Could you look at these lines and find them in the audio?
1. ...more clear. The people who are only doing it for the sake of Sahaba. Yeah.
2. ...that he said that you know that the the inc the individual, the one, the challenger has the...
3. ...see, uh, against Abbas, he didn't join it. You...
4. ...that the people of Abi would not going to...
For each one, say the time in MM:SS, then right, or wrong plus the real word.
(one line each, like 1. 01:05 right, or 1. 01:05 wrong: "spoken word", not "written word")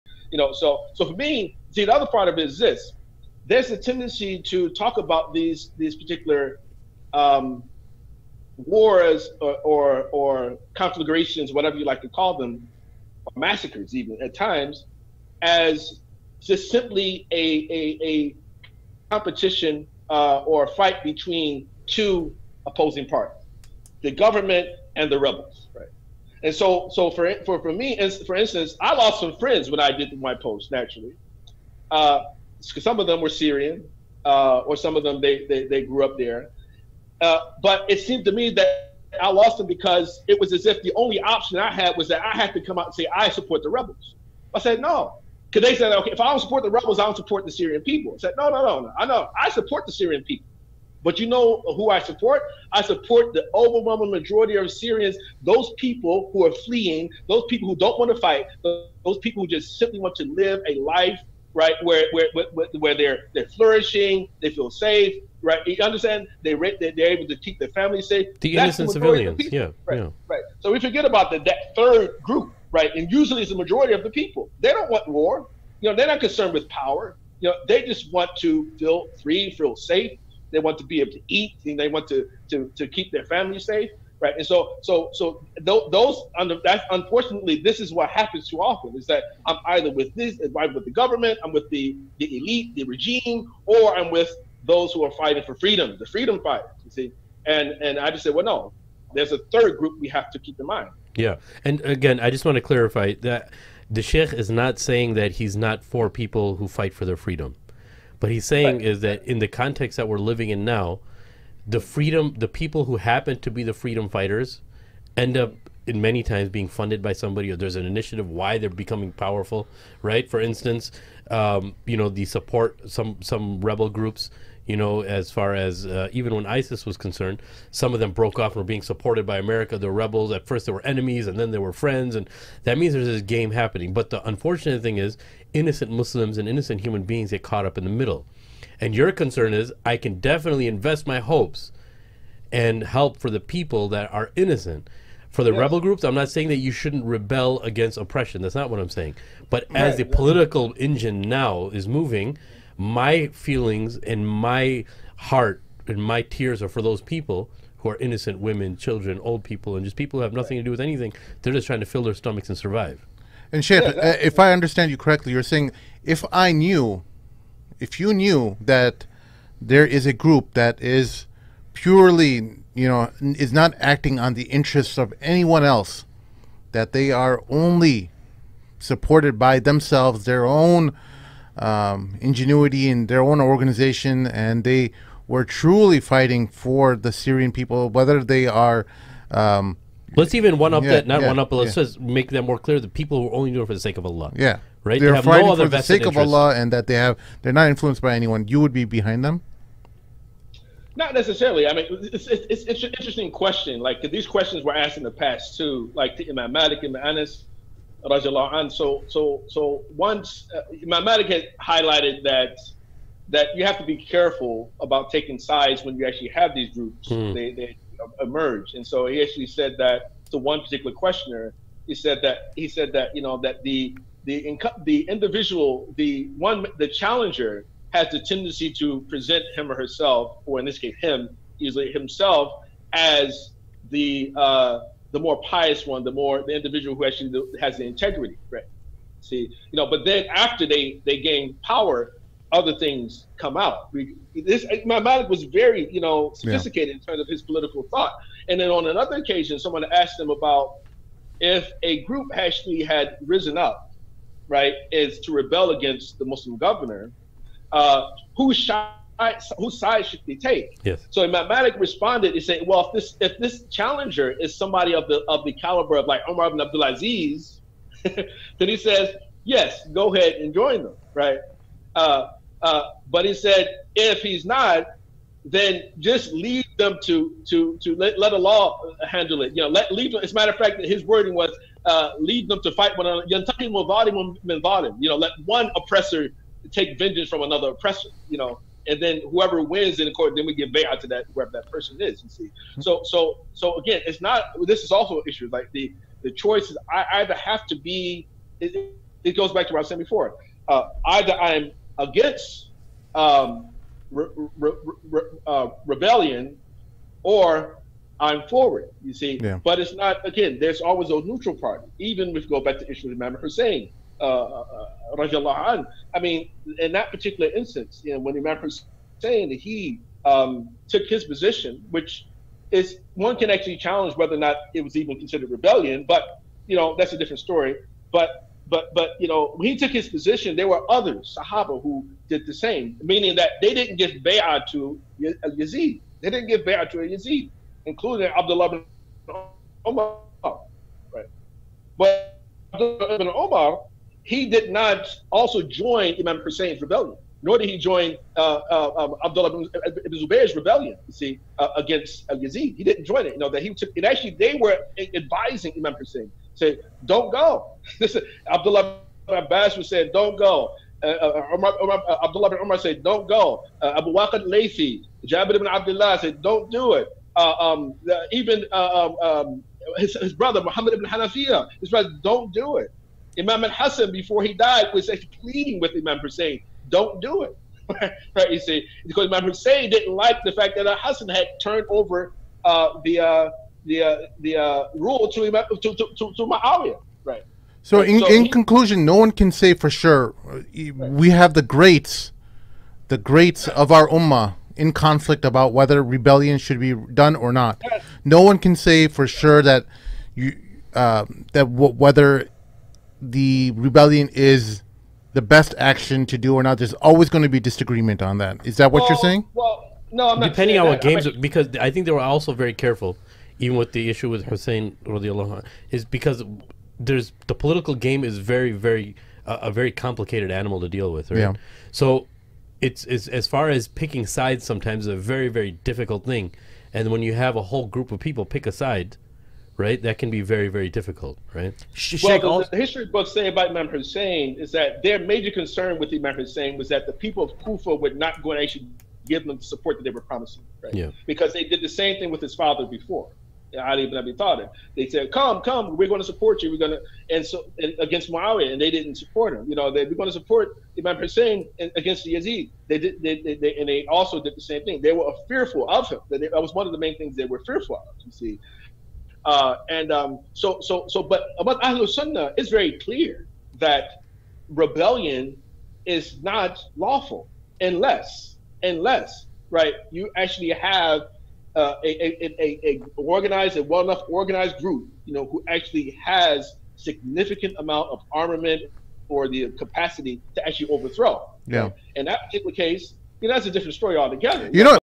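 1. 03:12 wrong: "Allah", not "Sahaba"
2. 03:42 right
3. 05:51 wrong: "Yazid", not "Abbas"
4. 07:16 wrong: "Kufa", not "Abi".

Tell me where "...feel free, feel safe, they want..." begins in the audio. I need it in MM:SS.
01:18.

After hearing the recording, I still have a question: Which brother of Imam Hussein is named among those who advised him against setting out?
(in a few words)
Muhammad ibn Hanafiya.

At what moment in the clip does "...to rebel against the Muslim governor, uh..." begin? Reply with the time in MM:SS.
04:15.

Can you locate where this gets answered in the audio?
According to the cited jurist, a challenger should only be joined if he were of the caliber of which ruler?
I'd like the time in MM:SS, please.
04:26.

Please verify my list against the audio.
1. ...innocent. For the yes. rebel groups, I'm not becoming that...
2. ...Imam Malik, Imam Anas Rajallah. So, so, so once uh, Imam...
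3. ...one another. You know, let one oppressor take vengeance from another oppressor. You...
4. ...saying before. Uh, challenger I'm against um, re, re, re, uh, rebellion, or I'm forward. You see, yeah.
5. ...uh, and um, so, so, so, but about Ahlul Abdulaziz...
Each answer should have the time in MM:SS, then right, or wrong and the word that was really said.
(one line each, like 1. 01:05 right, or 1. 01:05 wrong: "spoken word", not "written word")
1. 02:24 wrong: "saying", not "becoming"
2. 03:26 right
3. 04:42 right
4. 04:59 wrong: "either", not "challenger"
5. 07:39 wrong: "Sunnah", not "Abdulaziz".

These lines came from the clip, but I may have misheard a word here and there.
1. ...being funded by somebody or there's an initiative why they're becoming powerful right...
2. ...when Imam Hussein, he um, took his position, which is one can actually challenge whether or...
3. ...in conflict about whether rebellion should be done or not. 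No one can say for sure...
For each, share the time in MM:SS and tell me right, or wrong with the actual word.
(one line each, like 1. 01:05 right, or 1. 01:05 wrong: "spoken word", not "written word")
1. 01:56 right
2. 05:18 right
3. 06:34 right.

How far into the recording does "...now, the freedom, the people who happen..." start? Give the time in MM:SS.
01:50.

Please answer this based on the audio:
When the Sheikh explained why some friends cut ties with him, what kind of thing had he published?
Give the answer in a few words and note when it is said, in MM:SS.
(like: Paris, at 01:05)
post, at 00:30.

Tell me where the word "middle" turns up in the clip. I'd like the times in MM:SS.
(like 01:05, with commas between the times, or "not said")
02:17.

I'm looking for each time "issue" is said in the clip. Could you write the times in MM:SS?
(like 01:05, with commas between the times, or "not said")
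04:55, 05:12, 06:54.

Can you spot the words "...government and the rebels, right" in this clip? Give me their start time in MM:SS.
00:24.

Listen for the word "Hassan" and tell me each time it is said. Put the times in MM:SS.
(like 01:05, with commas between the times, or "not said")
06:13, 06:20.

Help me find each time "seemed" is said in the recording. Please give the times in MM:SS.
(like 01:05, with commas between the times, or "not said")
00:37.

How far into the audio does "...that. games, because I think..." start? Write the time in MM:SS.
06:51.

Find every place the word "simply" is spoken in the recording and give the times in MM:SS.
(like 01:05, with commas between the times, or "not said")
00:16, 00:59.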